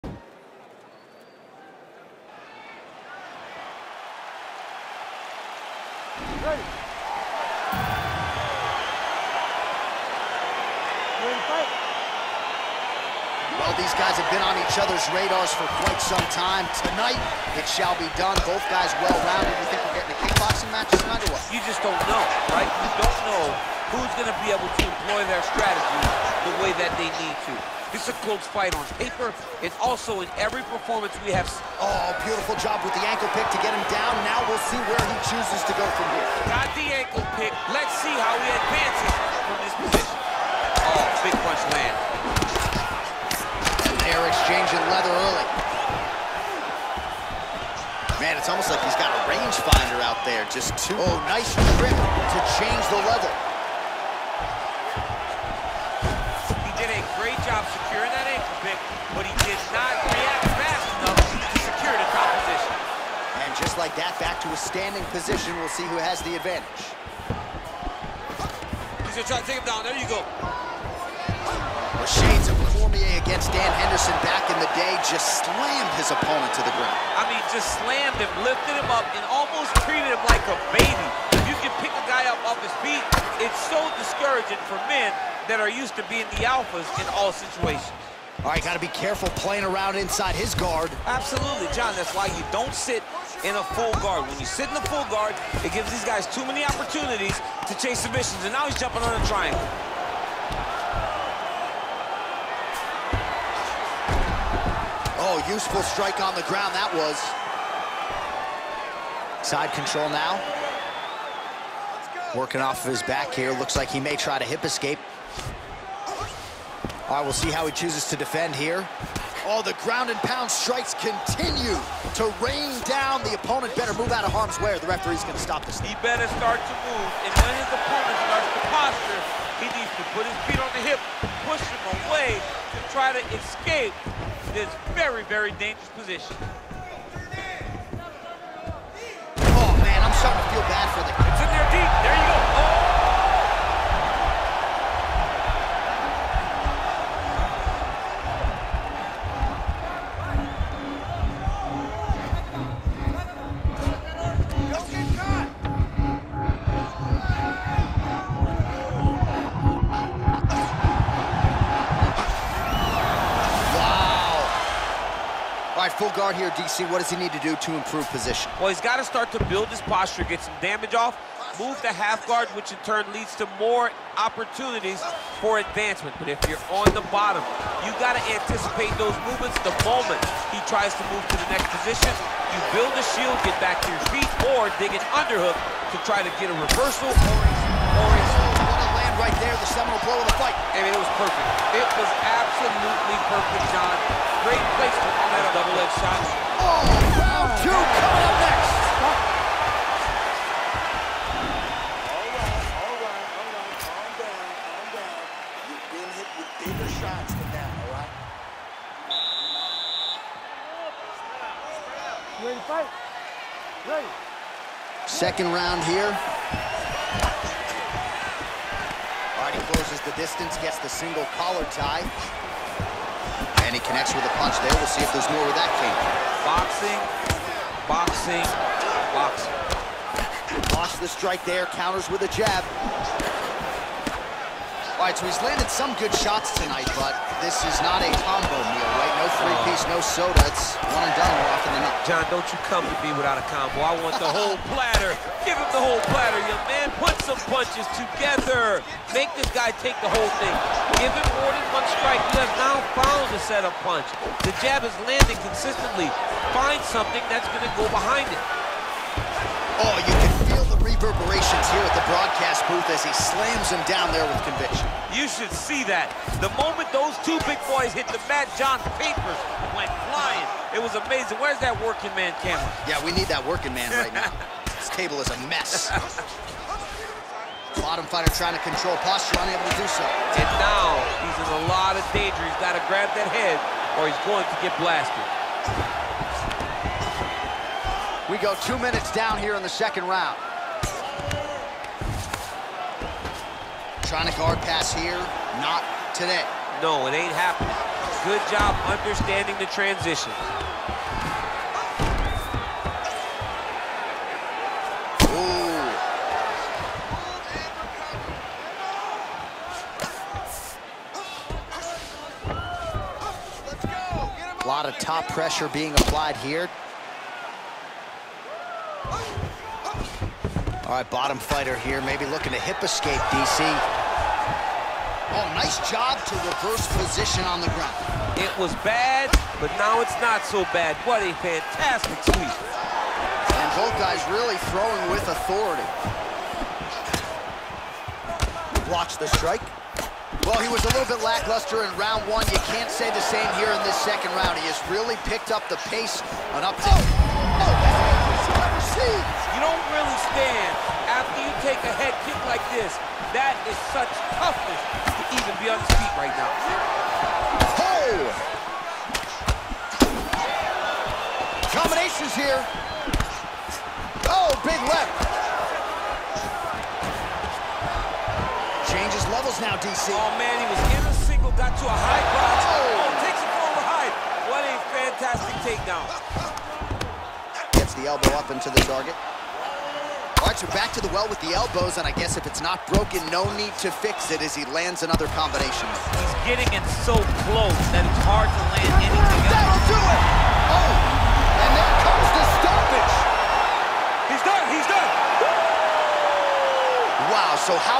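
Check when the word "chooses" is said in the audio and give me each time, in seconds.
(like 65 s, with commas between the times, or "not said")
35 s, 117 s.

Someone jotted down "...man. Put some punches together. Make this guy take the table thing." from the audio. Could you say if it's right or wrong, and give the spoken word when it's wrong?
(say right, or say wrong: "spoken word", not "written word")
wrong: "whole", not "table".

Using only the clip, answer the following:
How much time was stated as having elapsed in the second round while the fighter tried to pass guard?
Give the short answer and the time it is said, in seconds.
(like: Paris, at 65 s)
2 minutes, at 288 s.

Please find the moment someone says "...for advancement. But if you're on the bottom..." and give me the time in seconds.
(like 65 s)
175 s.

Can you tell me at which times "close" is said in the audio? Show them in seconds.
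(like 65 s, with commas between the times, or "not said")
28 s, 219 s, 387 s.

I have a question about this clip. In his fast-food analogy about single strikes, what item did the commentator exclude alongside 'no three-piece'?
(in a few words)
Soda.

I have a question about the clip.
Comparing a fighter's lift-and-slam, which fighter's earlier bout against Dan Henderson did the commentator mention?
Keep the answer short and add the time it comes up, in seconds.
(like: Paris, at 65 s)
Poirier, at 73 s.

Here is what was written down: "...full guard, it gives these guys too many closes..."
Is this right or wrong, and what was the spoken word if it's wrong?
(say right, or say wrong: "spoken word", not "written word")
wrong: "opportunities", not "closes".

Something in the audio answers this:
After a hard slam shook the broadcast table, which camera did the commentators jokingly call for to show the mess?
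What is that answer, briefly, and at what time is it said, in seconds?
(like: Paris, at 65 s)
Working man camera, at 271 s.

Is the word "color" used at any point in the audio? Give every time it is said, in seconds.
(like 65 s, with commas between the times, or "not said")
not said.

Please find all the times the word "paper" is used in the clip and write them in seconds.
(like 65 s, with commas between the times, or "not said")
29 s, 269 s.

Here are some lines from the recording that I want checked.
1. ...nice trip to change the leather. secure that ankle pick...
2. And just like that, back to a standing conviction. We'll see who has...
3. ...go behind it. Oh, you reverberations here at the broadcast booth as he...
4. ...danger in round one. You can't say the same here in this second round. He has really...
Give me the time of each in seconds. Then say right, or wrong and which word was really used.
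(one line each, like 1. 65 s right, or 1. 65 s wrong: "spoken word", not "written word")
1. 51 s right
2. 63 s wrong: "position", not "conviction"
3. 257 s right
4. 341 s wrong: "lackluster", not "danger".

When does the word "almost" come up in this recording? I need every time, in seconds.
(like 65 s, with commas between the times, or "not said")
48 s, 79 s.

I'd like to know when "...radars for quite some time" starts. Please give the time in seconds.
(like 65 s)
15 s.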